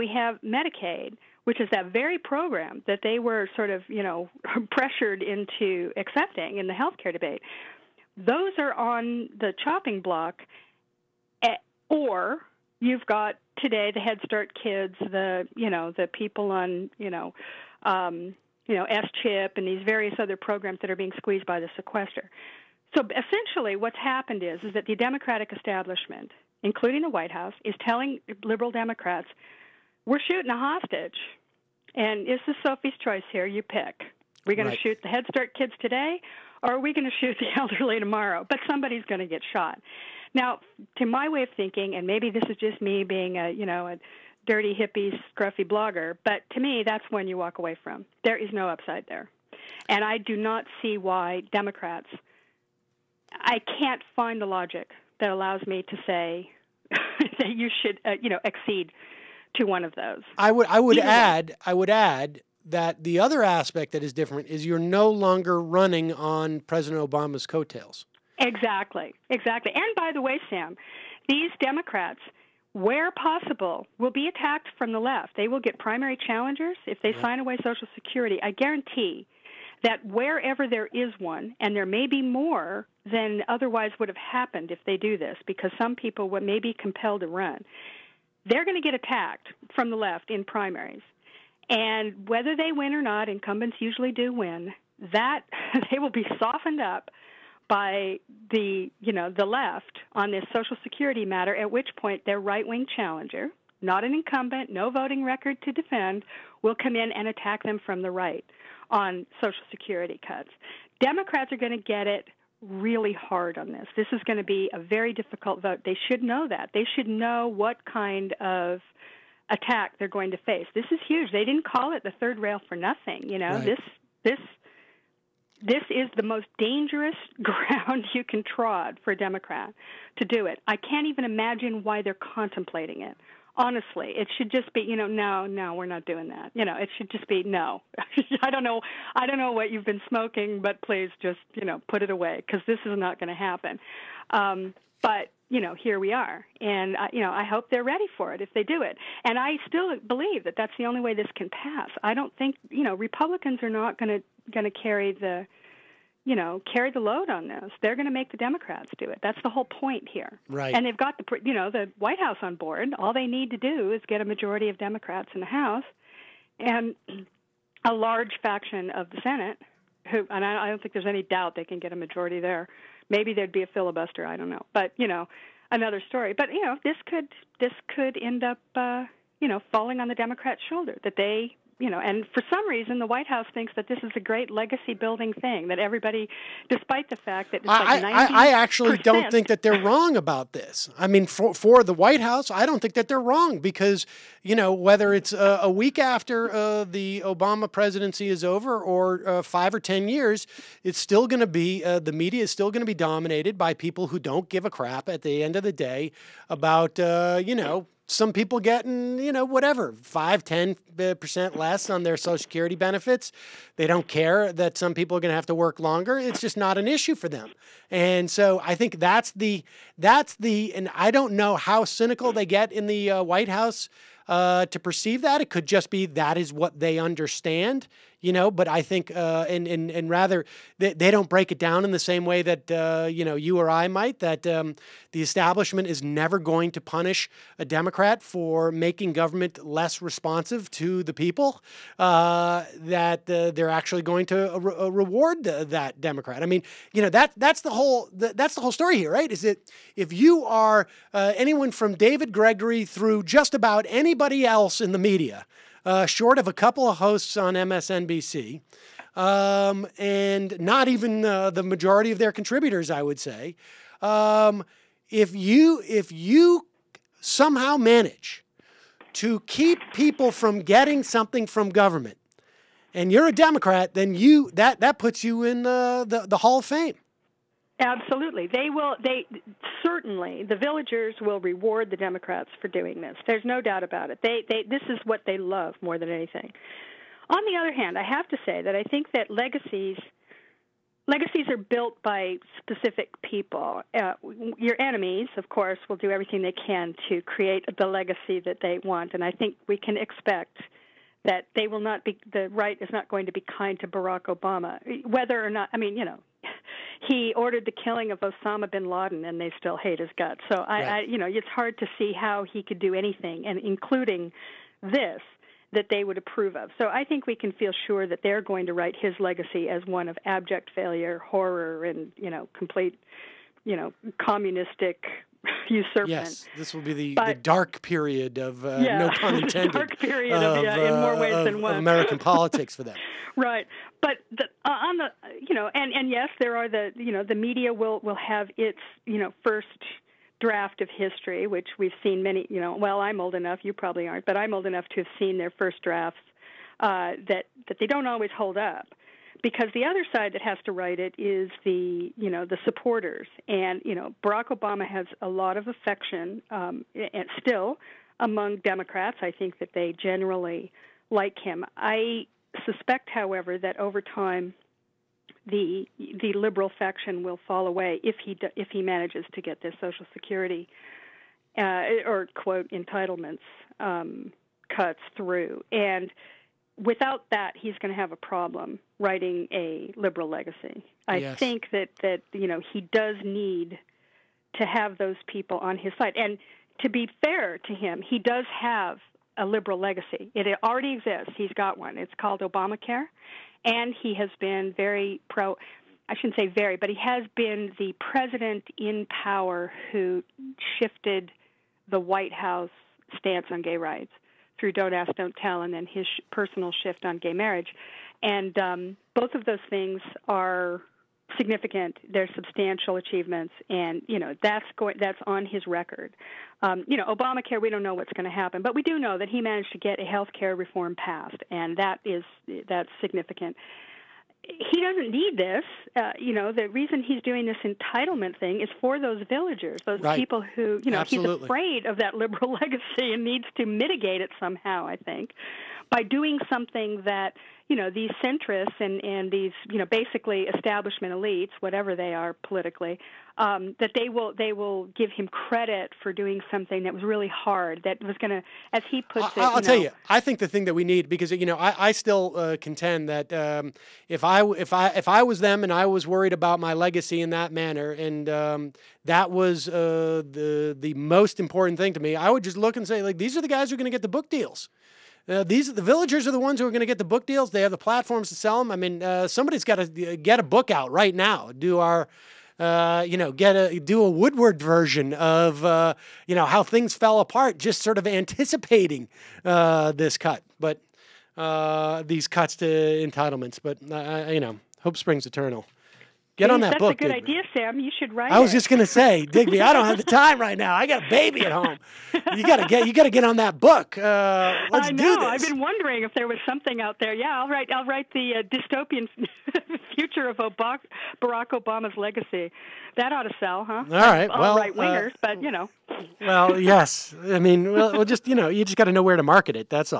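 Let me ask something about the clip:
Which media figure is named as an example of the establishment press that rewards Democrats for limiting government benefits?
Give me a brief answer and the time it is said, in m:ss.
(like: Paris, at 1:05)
David Gregory, at 4:11.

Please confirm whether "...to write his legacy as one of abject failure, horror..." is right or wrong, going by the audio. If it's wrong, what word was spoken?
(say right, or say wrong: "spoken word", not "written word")
right.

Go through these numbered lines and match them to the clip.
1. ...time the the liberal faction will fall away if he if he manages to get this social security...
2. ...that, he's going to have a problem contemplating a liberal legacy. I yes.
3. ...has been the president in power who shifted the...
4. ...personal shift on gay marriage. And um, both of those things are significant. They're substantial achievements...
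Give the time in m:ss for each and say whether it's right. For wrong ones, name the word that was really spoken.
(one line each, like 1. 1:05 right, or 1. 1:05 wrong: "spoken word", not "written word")
1. 6:04 right
2. 6:17 wrong: "writing", not "contemplating"
3. 6:37 right
4. 6:46 right.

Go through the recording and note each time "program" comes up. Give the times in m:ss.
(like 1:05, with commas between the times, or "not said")
0:02, 0:20.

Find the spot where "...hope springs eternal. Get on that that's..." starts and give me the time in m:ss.
8:04.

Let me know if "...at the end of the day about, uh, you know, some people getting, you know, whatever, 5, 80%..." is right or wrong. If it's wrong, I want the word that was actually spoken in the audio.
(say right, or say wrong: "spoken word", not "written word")
wrong: "10", not "80".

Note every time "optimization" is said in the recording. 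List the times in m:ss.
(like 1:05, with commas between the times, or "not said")
not said.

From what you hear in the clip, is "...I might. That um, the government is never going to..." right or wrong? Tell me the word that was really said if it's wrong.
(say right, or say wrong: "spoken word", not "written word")
wrong: "establishment", not "government".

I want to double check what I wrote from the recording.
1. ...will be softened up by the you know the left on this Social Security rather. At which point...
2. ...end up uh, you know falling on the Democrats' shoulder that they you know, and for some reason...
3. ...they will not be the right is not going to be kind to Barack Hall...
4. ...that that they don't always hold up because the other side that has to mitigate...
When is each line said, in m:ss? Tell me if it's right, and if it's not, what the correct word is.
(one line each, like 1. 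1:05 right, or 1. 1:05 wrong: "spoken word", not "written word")
1. 1:35 wrong: "matter", not "rather"
2. 2:58 right
3. 5:01 wrong: "Obama", not "Hall"
4. 5:47 wrong: "write", not "mitigate".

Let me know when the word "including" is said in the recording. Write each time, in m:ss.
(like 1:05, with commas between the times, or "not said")
0:26, 5:13.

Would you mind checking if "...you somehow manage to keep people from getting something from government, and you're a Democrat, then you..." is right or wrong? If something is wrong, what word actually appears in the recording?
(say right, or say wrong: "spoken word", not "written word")
right.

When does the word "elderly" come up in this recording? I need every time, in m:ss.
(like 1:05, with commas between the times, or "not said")
0:37.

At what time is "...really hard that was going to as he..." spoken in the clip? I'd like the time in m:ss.
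7:27.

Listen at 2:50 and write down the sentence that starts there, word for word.
Who and I, I don't think there's any doubt they can get a majority there.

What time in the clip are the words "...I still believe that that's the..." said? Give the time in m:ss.
2:29.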